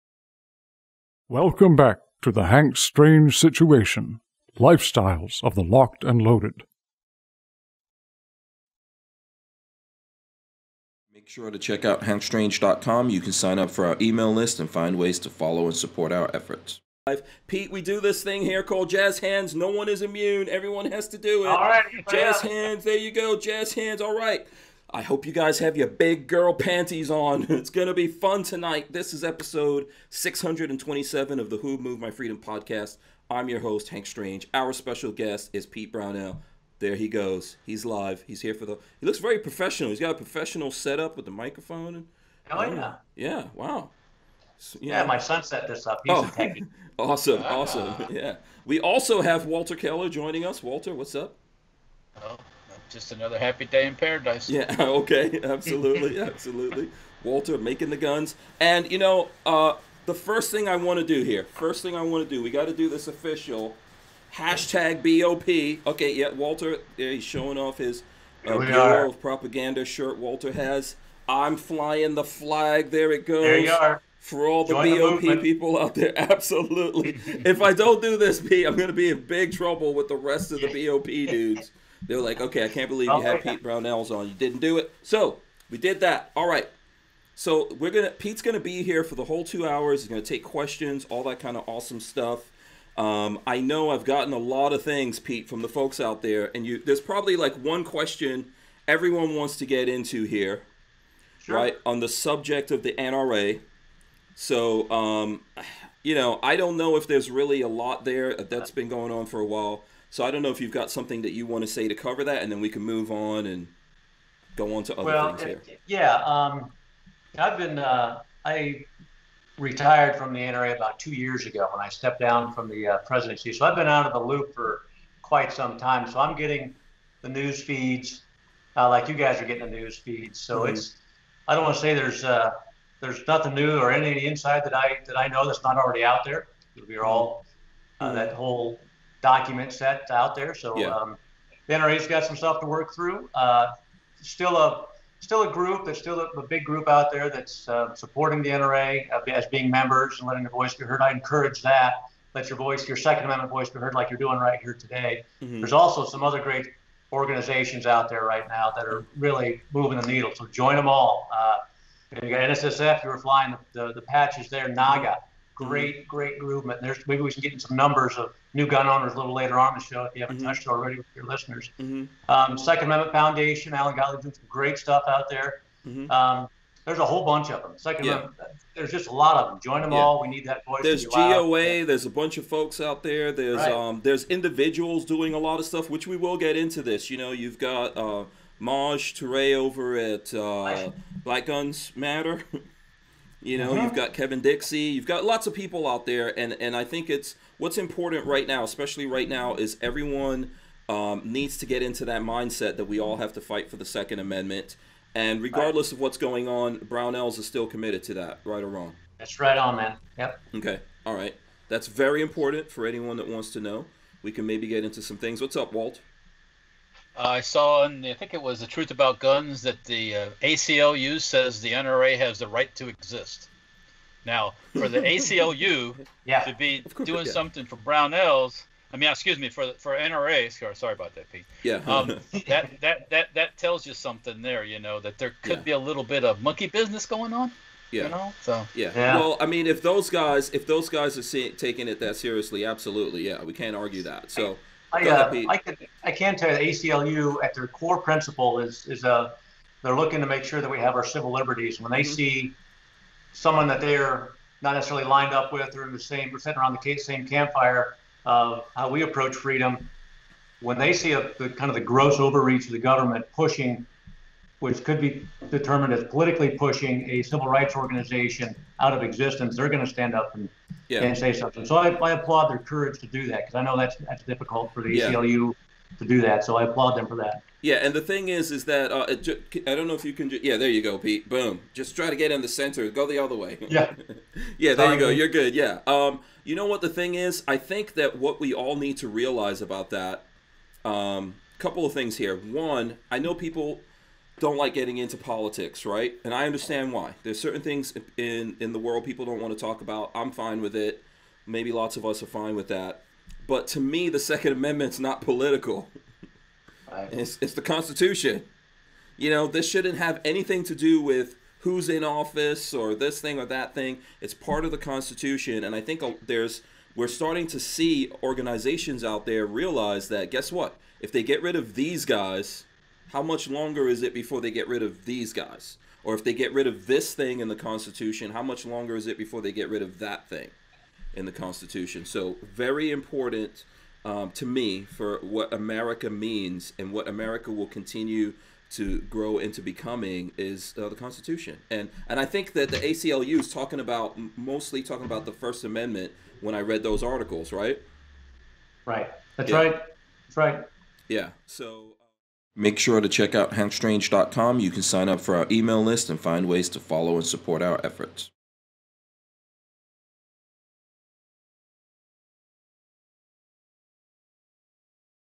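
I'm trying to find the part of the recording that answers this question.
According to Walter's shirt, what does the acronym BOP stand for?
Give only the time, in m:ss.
1:08.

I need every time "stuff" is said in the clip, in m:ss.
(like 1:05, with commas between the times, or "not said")
1:31, 2:22, 2:54, 3:05.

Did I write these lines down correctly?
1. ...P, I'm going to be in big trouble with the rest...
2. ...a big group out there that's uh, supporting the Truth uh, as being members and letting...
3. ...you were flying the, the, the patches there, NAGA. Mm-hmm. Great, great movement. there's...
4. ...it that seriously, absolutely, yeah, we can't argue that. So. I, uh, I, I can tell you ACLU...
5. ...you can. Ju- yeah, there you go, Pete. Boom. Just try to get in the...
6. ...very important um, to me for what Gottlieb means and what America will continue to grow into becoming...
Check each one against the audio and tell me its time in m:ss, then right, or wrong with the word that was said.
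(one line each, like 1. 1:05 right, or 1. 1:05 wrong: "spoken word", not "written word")
1. 1:18 right
2. 2:26 wrong: "NRA", not "Truth"
3. 2:43 right
4. 4:01 right
5. 4:40 right
6. 5:32 wrong: "America", not "Gottlieb".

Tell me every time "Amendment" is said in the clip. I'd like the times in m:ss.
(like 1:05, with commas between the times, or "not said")
2:33, 2:52, 2:58, 3:24, 5:04, 5:45.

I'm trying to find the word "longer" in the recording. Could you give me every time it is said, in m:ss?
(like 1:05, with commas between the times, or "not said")
5:23, 5:28.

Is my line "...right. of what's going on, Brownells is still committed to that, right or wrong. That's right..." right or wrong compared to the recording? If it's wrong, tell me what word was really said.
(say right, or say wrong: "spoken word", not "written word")
right.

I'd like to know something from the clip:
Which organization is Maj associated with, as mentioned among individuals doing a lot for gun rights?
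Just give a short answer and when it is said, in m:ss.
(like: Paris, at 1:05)
Black Guns Matter, at 3:11.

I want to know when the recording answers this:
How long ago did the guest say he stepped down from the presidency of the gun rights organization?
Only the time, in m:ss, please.
2:00.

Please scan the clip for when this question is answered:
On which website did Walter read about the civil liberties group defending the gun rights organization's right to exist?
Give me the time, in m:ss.
3:38.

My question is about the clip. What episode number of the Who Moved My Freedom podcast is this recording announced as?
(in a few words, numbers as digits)
627.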